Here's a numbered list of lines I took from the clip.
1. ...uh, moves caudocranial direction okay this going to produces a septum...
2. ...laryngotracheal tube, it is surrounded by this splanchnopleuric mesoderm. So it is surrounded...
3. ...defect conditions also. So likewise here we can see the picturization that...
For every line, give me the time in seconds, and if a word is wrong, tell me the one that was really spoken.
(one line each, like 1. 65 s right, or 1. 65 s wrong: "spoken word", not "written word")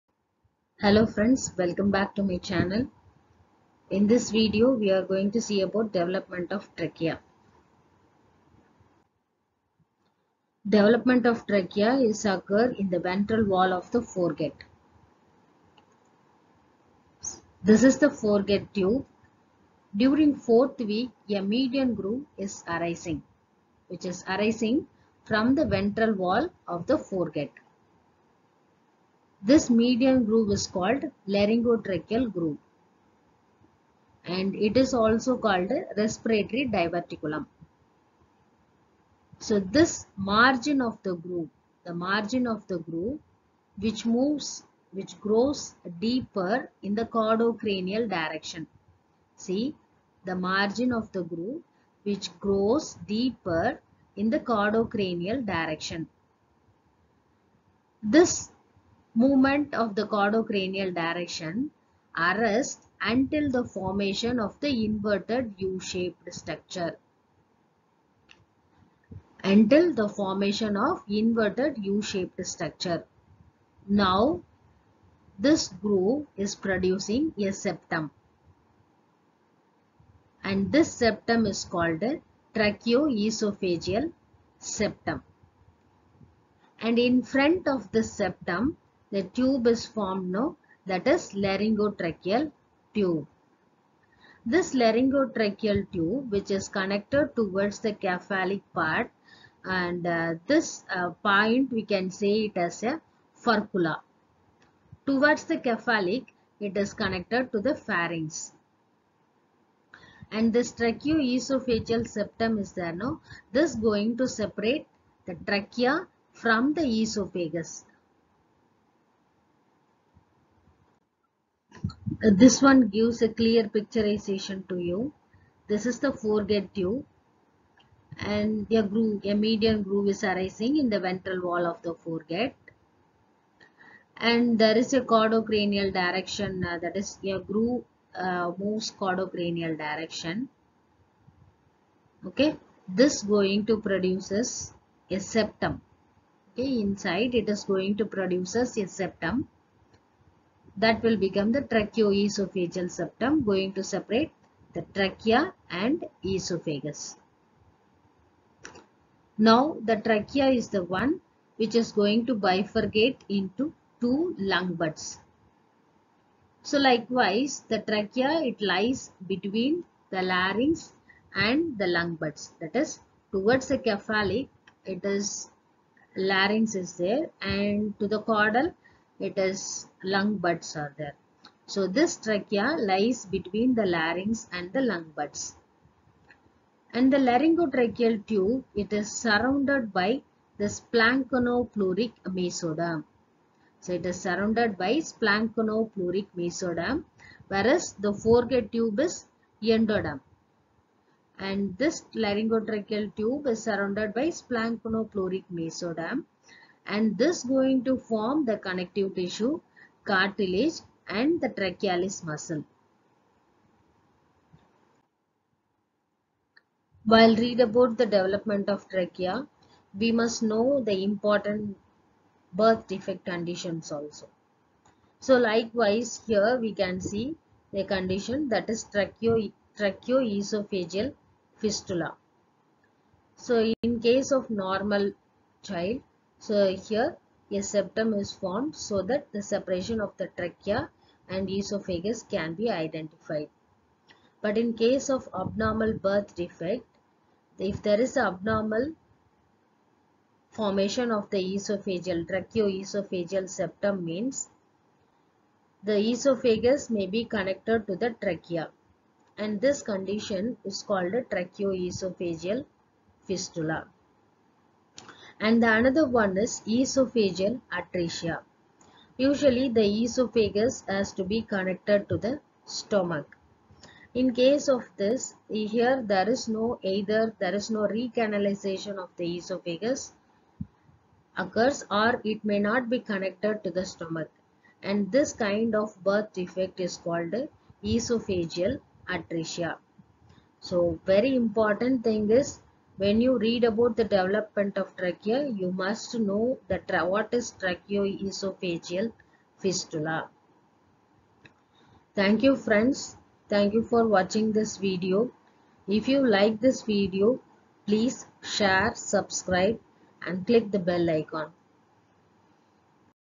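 1. 138 s right
2. 187 s right
3. 222 s wrong: "condition", not "picturization".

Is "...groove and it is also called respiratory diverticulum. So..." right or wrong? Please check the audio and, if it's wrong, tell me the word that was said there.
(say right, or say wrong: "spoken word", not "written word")
right.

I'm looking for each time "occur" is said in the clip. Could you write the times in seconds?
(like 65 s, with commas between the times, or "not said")
12 s, 281 s.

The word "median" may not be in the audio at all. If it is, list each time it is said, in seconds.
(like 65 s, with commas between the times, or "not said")
21 s, 29 s, 129 s.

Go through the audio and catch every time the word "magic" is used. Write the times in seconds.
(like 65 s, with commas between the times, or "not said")
not said.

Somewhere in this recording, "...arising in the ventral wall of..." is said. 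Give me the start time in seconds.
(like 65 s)
130 s.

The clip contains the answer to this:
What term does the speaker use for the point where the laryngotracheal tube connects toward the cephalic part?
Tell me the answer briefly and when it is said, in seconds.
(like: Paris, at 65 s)
furcula, at 103 s.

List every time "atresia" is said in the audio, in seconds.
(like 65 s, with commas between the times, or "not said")
267 s, 289 s.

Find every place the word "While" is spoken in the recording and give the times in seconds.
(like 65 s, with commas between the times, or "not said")
217 s.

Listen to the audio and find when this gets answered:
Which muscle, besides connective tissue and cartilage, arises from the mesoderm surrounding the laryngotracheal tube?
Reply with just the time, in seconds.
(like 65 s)
211 s.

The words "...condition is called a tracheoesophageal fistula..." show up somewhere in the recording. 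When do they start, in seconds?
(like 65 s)
259 s.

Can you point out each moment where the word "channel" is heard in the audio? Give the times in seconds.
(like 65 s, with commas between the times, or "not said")
2 s.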